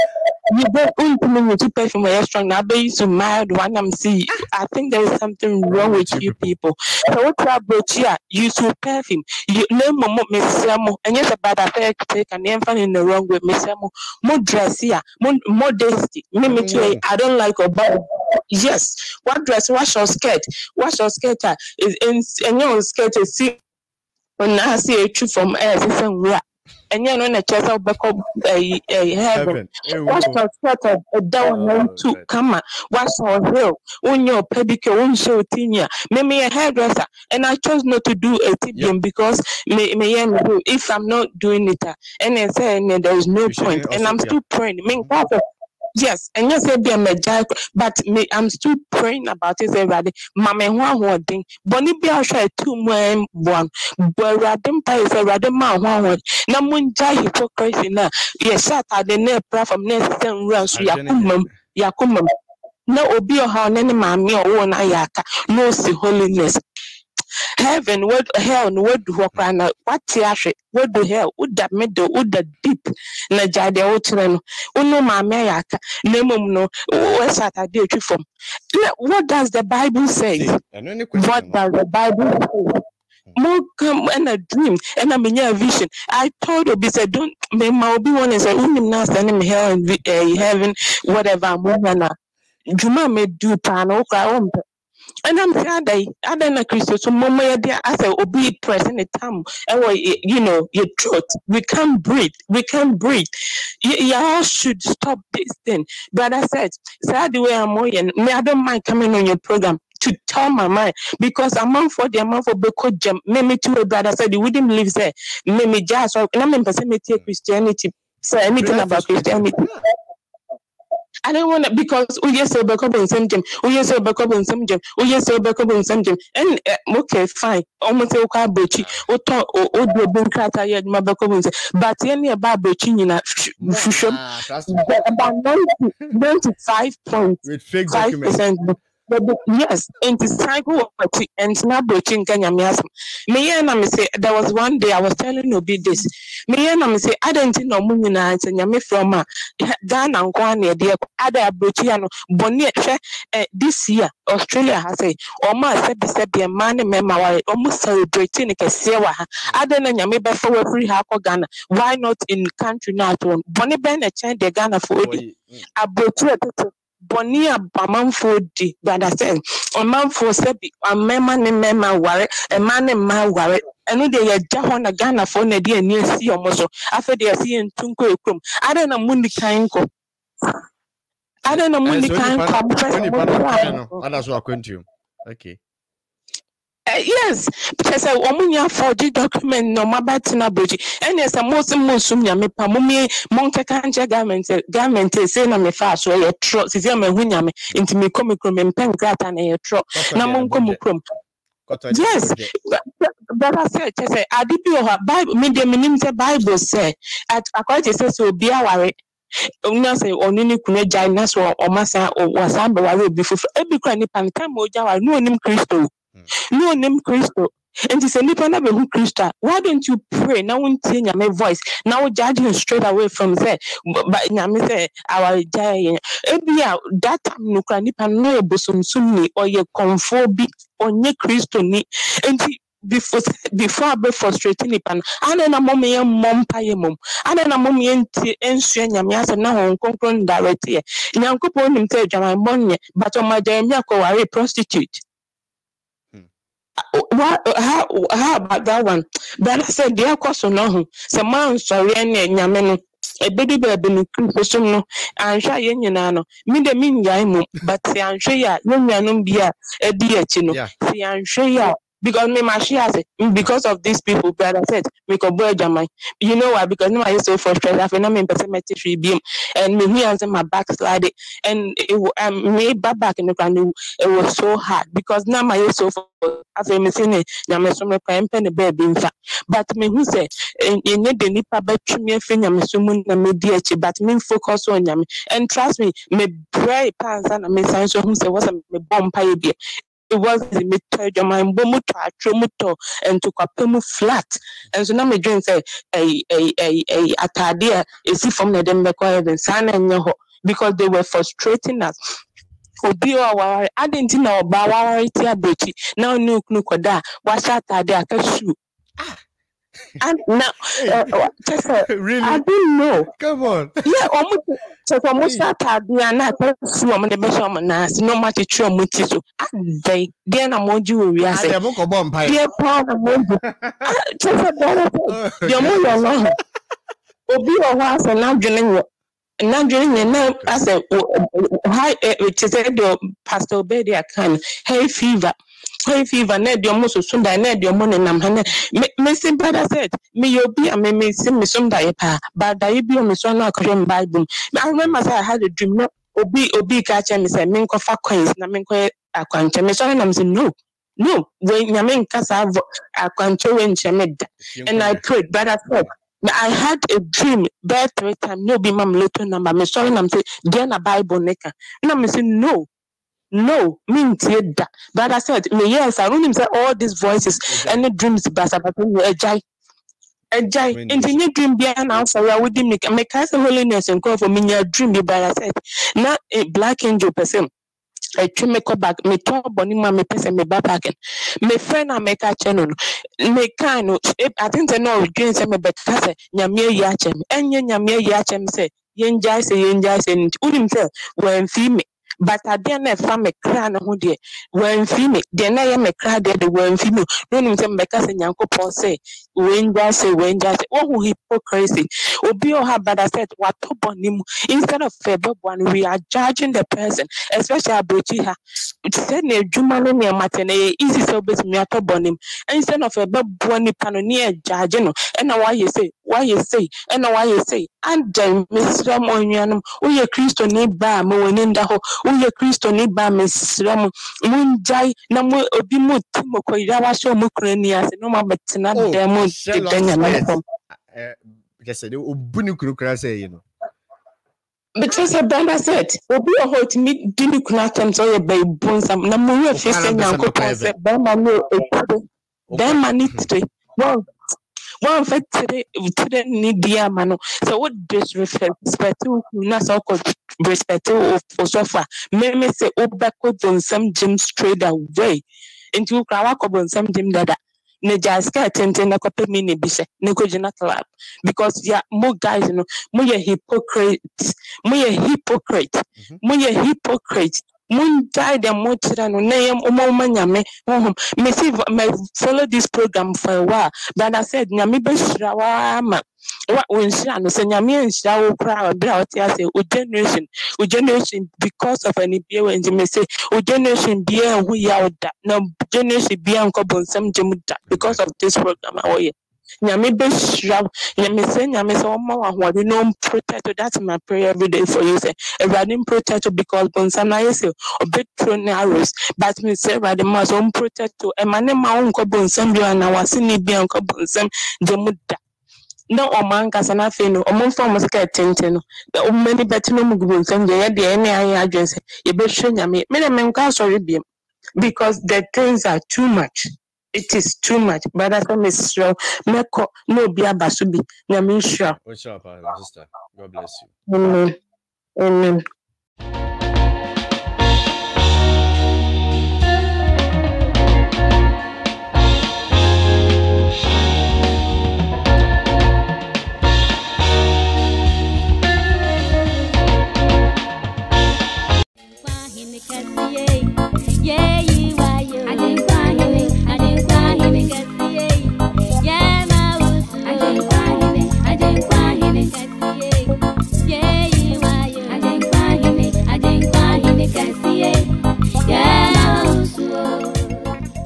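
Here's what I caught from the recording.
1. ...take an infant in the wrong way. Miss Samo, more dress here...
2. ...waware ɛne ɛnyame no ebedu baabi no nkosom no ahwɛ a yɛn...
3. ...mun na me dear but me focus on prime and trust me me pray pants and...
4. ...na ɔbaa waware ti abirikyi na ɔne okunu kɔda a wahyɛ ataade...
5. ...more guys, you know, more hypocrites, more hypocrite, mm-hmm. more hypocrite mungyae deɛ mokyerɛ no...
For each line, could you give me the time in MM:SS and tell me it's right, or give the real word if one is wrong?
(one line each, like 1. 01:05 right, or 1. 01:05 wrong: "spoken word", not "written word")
1. 00:12 right
2. 04:11 wrong: "nsɔre", not "waware"
3. 04:42 wrong: "nyame", not "prime"
4. 05:04 right
5. 07:41 right.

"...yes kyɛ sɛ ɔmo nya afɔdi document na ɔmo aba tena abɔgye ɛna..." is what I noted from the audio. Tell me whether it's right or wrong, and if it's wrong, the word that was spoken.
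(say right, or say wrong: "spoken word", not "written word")
right.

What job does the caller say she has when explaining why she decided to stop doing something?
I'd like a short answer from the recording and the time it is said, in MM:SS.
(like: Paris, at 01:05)
hairdresser, at 00:36.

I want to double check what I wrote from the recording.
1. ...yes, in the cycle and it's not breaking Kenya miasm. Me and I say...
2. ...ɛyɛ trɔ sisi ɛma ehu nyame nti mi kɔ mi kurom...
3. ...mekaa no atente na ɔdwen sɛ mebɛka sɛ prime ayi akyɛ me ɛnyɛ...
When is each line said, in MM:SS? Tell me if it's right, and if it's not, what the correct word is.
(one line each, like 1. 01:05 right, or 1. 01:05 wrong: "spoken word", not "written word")
1. 02:19 right
2. 03:16 right
3. 06:23 wrong: "nyame", not "prime".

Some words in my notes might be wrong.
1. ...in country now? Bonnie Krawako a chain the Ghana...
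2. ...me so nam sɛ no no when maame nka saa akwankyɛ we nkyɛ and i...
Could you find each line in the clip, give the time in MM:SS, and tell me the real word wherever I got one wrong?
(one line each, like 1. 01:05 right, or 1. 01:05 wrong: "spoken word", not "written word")
1. 02:42 wrong: "Ben", not "Krawako"
2. 05:49 wrong: "nyame", not "maame".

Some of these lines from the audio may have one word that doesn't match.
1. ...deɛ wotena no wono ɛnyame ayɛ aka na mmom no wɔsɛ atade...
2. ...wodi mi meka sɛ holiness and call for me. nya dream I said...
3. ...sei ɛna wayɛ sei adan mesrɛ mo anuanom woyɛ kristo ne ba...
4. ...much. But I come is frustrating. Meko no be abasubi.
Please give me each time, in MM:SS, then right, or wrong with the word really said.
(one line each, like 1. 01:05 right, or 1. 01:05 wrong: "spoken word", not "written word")
1. 01:13 wrong: "maame", not "ɛnyame"
2. 06:12 right
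3. 06:56 right
4. 08:37 wrong: "strong", not "frustrating".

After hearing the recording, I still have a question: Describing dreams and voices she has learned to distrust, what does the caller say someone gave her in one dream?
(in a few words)
lotto number.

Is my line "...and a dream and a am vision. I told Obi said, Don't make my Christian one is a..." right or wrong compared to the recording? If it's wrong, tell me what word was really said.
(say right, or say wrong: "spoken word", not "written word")
wrong: "Obi", not "Christian".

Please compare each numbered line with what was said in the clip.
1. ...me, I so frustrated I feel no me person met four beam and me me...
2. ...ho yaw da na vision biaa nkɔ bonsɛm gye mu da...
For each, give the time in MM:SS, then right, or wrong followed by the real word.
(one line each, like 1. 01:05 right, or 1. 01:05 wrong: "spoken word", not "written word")
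1. 04:26 wrong: "three", not "four"
2. 08:04 wrong: "generation", not "vision".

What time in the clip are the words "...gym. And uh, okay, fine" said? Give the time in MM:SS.
02:06.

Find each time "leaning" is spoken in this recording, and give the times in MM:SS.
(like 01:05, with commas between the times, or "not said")
not said.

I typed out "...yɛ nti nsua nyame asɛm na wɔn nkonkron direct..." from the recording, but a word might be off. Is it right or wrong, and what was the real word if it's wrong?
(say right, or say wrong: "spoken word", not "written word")
right.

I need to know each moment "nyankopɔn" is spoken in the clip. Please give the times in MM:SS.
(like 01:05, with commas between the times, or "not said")
04:01, 06:38, 07:19.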